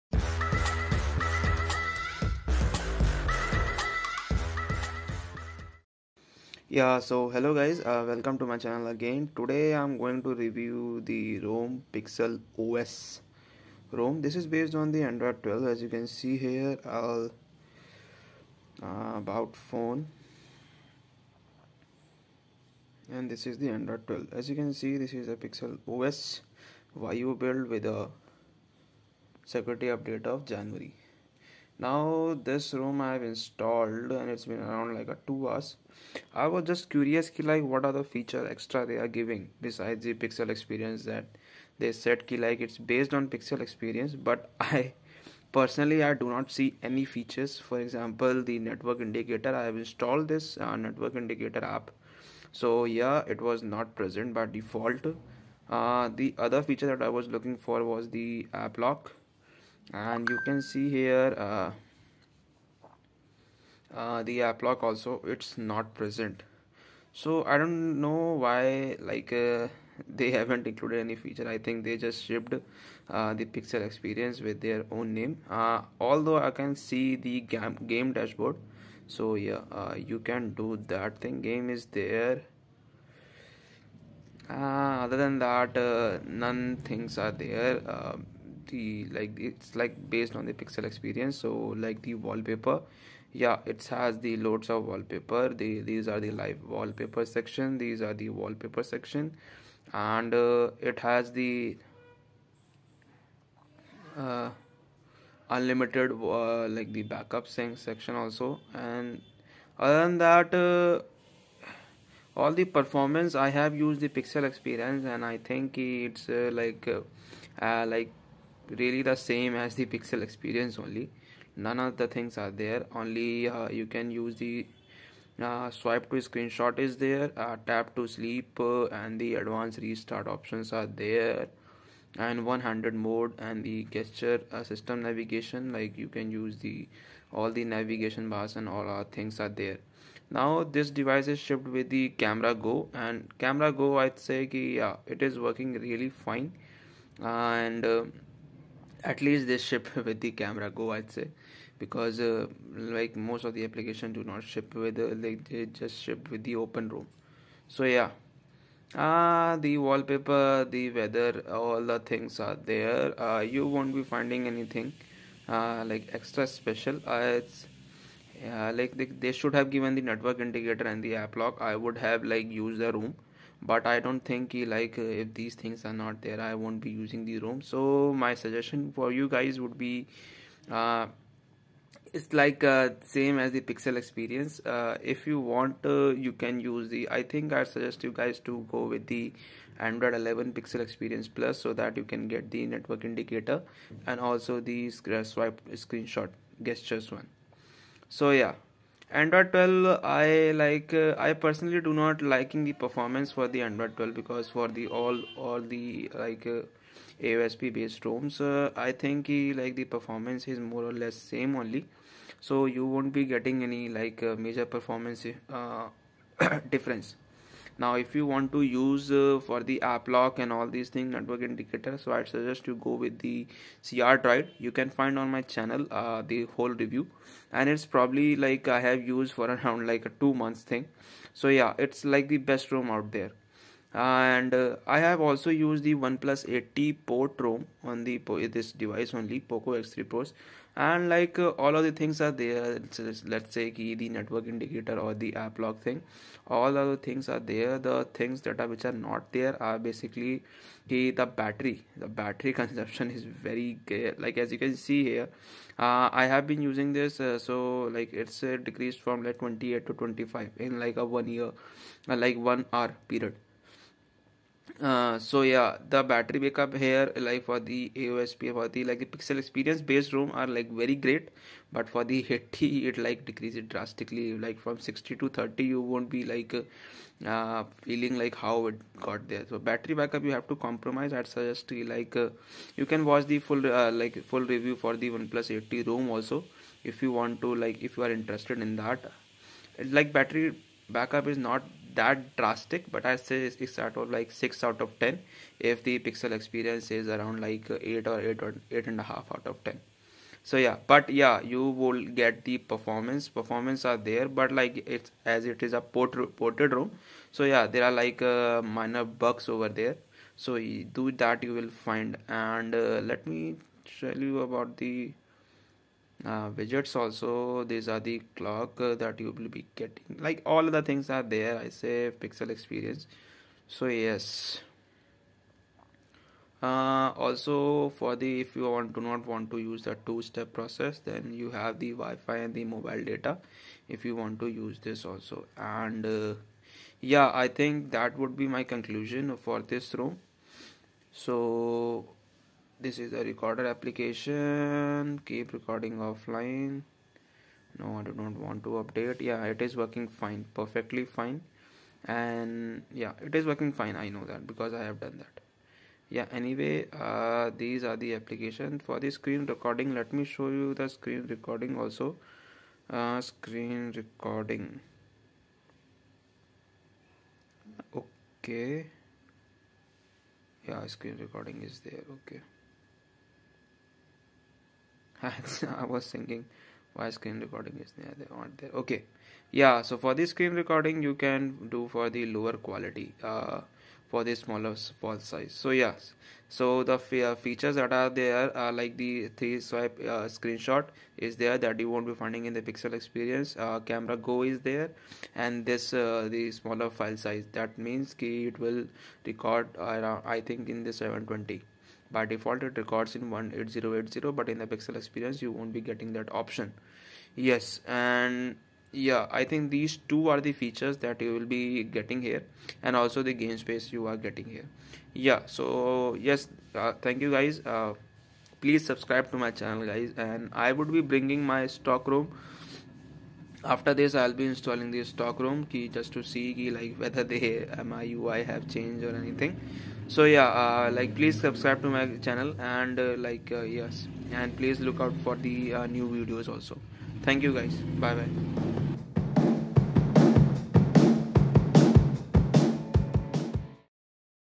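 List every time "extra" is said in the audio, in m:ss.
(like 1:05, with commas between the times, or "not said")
0:38, 2:46.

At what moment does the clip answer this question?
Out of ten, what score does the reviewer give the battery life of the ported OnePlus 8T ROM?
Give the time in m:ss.
4:54.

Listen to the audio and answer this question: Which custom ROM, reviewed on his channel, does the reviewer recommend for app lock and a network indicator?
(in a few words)
crDroid.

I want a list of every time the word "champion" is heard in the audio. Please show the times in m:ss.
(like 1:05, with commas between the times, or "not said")
not said.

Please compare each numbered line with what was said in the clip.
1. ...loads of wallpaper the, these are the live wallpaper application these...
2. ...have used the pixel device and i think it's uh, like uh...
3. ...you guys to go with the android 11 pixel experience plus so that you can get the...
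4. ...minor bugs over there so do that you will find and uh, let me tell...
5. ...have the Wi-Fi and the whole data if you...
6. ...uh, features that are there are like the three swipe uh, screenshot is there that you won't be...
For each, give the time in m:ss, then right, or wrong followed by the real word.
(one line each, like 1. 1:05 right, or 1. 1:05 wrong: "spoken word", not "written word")
1. 1:34 wrong: "section", not "application"
2. 1:53 wrong: "experience", not "device"
3. 3:08 right
4. 5:08 right
5. 5:31 wrong: "mobile", not "whole"
6. 6:27 right.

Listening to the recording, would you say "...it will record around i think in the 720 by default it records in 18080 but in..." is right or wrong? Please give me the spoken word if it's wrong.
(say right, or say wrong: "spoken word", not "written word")
right.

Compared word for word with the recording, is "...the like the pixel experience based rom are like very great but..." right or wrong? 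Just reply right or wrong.
right.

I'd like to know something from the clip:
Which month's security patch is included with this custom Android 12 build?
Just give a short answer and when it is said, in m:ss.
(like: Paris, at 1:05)
January, at 0:30.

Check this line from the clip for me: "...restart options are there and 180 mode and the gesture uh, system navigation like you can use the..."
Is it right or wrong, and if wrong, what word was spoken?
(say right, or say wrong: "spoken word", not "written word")
wrong: "100", not "180".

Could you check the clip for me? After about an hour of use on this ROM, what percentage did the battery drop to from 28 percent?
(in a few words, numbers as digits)
25.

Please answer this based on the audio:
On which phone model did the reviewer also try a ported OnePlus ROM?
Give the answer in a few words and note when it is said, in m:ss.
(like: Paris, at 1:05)
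POCO X3 Pro, at 3:59.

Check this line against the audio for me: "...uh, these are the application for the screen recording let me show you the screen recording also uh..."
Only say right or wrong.
right.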